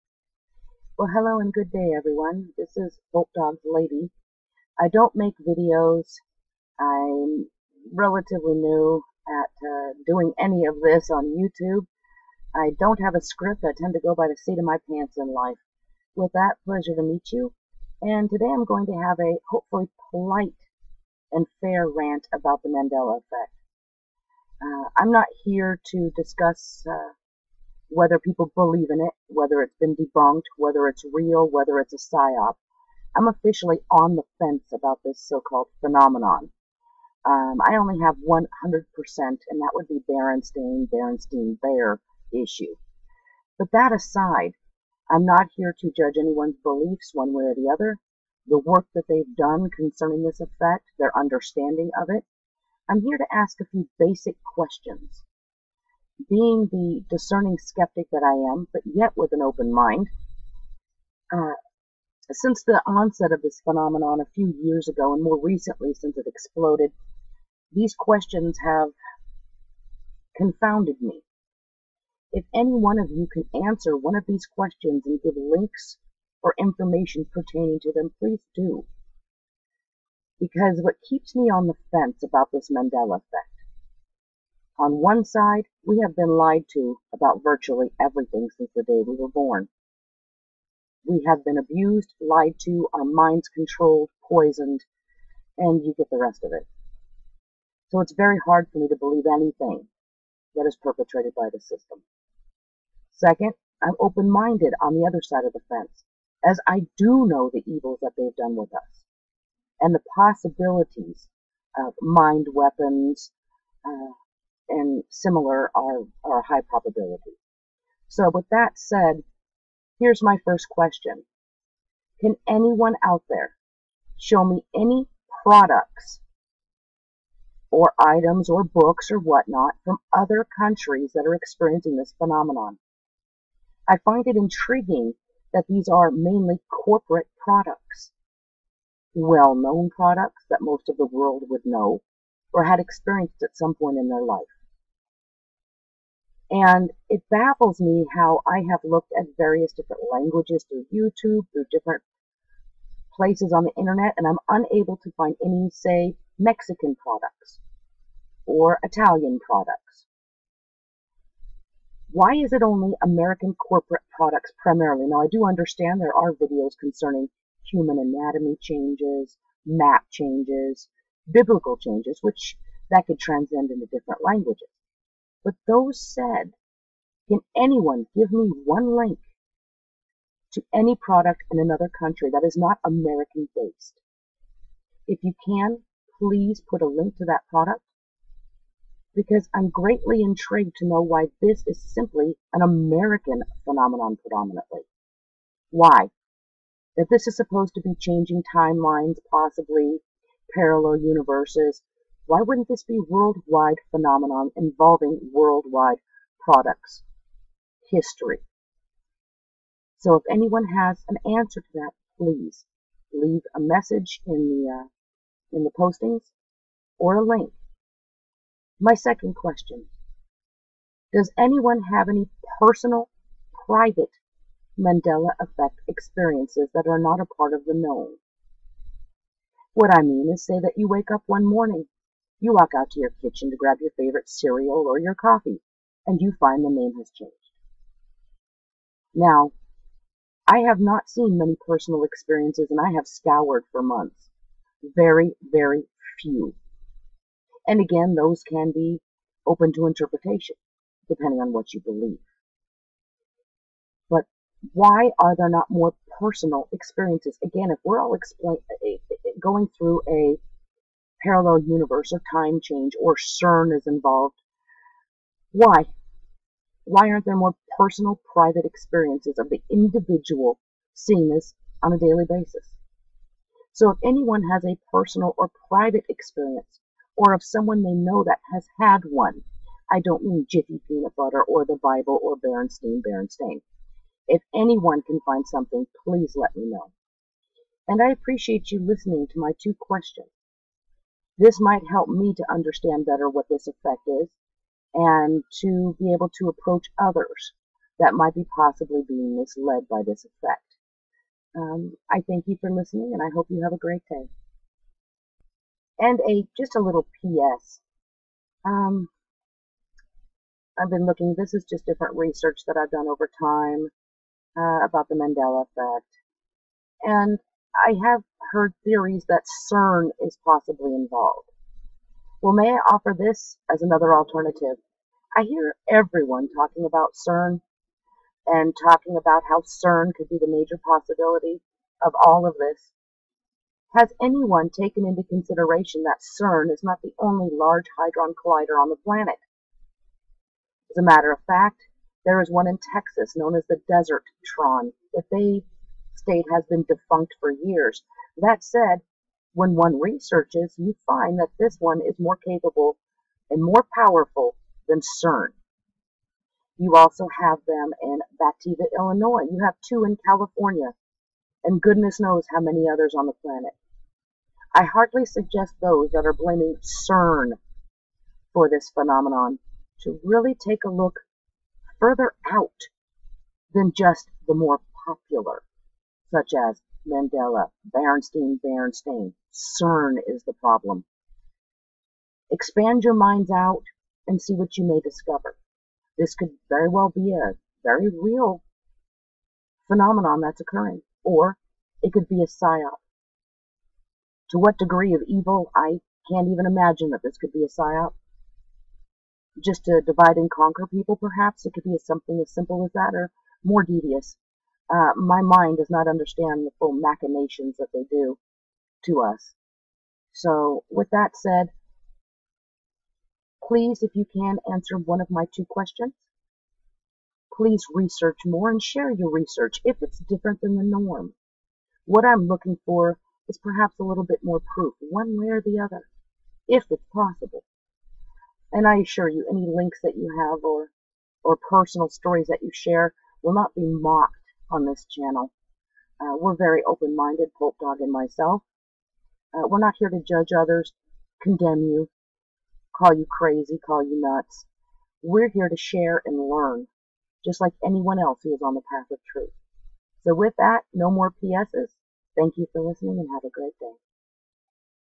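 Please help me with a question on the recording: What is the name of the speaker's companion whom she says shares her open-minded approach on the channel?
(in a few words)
Pope Dog.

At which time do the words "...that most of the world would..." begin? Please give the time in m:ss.
2:20.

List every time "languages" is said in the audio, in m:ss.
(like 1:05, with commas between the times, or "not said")
2:30, 2:54.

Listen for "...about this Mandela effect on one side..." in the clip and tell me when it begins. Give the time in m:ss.
1:22.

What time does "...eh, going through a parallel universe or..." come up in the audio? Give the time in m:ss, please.
4:19.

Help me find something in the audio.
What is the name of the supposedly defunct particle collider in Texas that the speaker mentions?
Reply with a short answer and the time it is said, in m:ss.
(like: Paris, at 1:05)
Desertron, at 5:43.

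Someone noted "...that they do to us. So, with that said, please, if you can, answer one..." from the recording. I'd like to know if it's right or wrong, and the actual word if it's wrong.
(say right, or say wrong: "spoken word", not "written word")
right.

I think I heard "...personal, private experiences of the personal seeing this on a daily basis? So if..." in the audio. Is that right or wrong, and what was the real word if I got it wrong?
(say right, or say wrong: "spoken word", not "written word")
wrong: "individual", not "personal".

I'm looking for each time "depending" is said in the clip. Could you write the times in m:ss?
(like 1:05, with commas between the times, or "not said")
4:11.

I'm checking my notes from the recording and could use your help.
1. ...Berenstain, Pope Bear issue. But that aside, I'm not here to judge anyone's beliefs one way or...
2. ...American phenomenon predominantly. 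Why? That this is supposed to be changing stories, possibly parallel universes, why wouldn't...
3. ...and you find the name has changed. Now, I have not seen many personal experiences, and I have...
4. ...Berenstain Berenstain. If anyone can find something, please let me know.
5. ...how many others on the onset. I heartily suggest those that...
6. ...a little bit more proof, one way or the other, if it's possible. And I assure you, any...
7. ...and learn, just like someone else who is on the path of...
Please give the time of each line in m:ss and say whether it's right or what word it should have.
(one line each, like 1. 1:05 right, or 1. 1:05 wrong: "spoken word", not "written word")
1. 0:40 wrong: "Berenstain", not "Pope"
2. 3:12 wrong: "timelines", not "stories"
3. 3:56 right
4. 4:42 right
5. 6:02 wrong: "planet", not "onset"
6. 7:03 right
7. 7:26 wrong: "anyone", not "someone".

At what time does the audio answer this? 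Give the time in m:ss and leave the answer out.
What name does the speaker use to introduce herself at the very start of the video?
0:03.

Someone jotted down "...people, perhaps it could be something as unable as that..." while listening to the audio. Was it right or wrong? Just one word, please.
wrong.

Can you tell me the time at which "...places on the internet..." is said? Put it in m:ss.
2:33.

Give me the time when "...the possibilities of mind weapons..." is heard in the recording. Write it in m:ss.
1:49.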